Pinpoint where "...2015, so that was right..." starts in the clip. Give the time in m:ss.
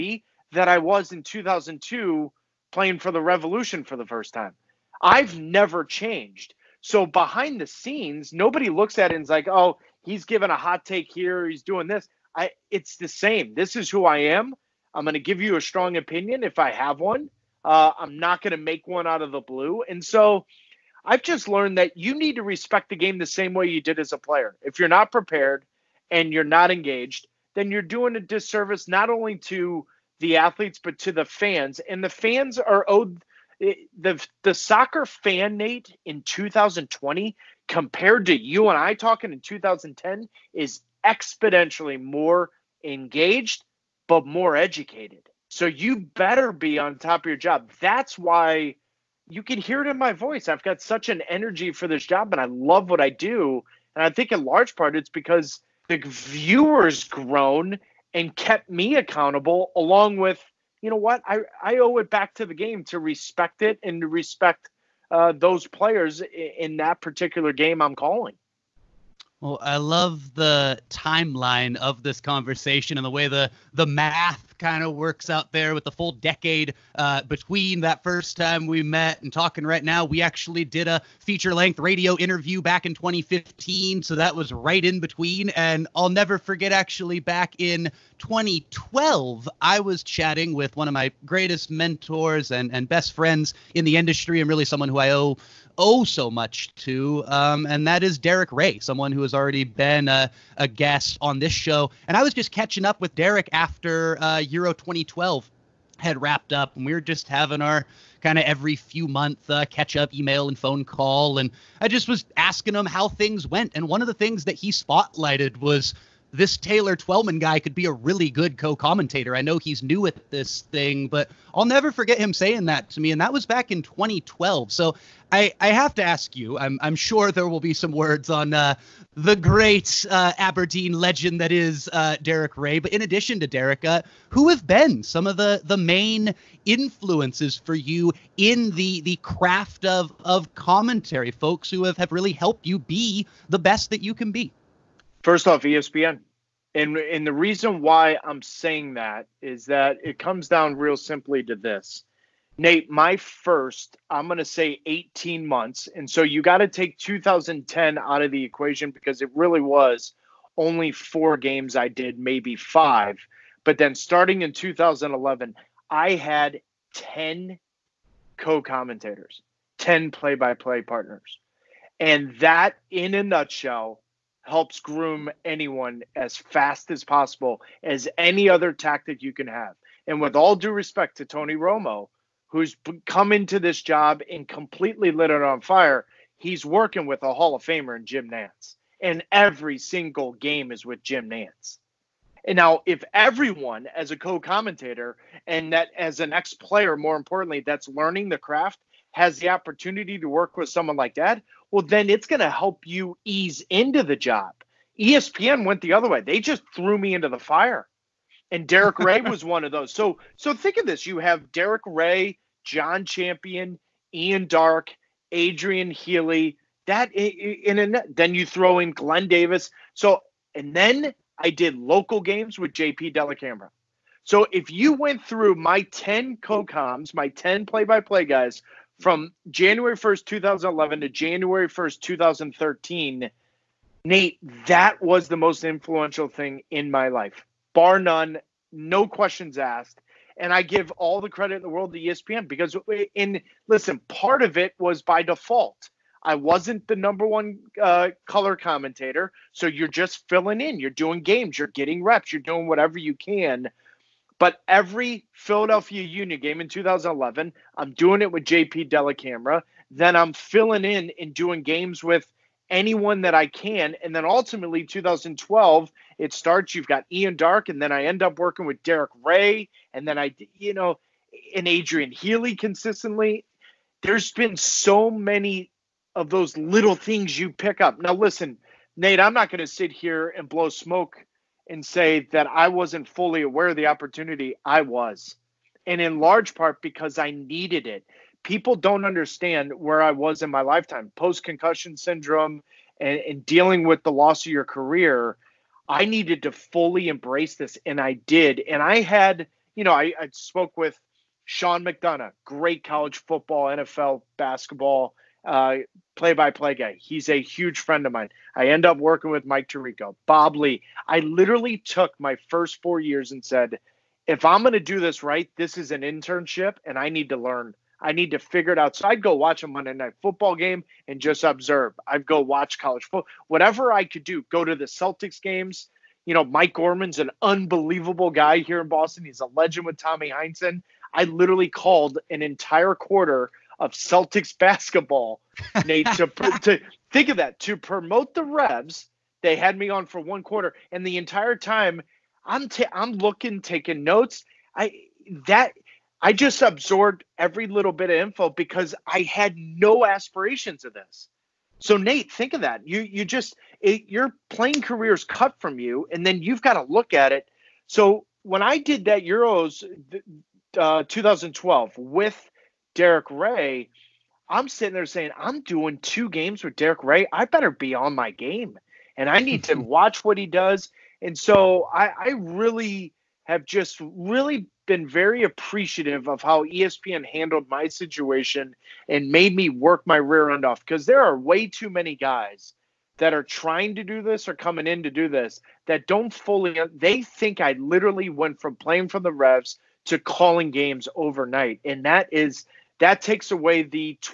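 1:22.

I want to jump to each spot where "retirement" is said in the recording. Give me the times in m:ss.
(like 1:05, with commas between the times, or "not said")
not said.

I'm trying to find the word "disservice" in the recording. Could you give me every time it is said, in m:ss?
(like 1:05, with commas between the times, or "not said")
0:28.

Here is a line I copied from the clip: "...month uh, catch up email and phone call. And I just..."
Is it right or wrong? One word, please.
right.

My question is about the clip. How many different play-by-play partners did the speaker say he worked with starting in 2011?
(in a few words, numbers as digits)
10.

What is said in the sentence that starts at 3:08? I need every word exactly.
And every single game is with Jim Nantz.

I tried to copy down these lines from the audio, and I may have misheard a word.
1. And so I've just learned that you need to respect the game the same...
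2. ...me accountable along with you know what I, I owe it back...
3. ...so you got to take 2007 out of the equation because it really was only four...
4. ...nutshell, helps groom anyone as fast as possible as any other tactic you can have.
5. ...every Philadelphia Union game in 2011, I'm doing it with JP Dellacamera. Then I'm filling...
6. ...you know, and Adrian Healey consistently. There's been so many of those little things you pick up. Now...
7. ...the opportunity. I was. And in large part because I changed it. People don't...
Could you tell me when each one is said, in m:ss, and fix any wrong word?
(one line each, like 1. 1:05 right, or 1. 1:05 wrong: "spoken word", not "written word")
1. 0:19 right
2. 0:58 right
3. 2:36 wrong: "2010", not "2007"
4. 2:53 right
5. 4:14 right
6. 4:30 right
7. 4:43 wrong: "needed", not "changed".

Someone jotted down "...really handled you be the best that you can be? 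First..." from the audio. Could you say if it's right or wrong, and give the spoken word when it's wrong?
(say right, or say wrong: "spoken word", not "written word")
wrong: "helped", not "handled".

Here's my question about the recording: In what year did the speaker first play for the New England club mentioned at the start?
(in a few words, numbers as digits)
2002.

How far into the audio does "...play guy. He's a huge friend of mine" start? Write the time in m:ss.
5:06.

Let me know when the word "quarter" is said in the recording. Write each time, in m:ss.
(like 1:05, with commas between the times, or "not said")
5:32, 5:40.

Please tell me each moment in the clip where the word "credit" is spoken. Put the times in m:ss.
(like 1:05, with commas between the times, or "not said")
4:01.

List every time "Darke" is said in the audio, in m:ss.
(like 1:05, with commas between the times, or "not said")
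3:34, 4:27.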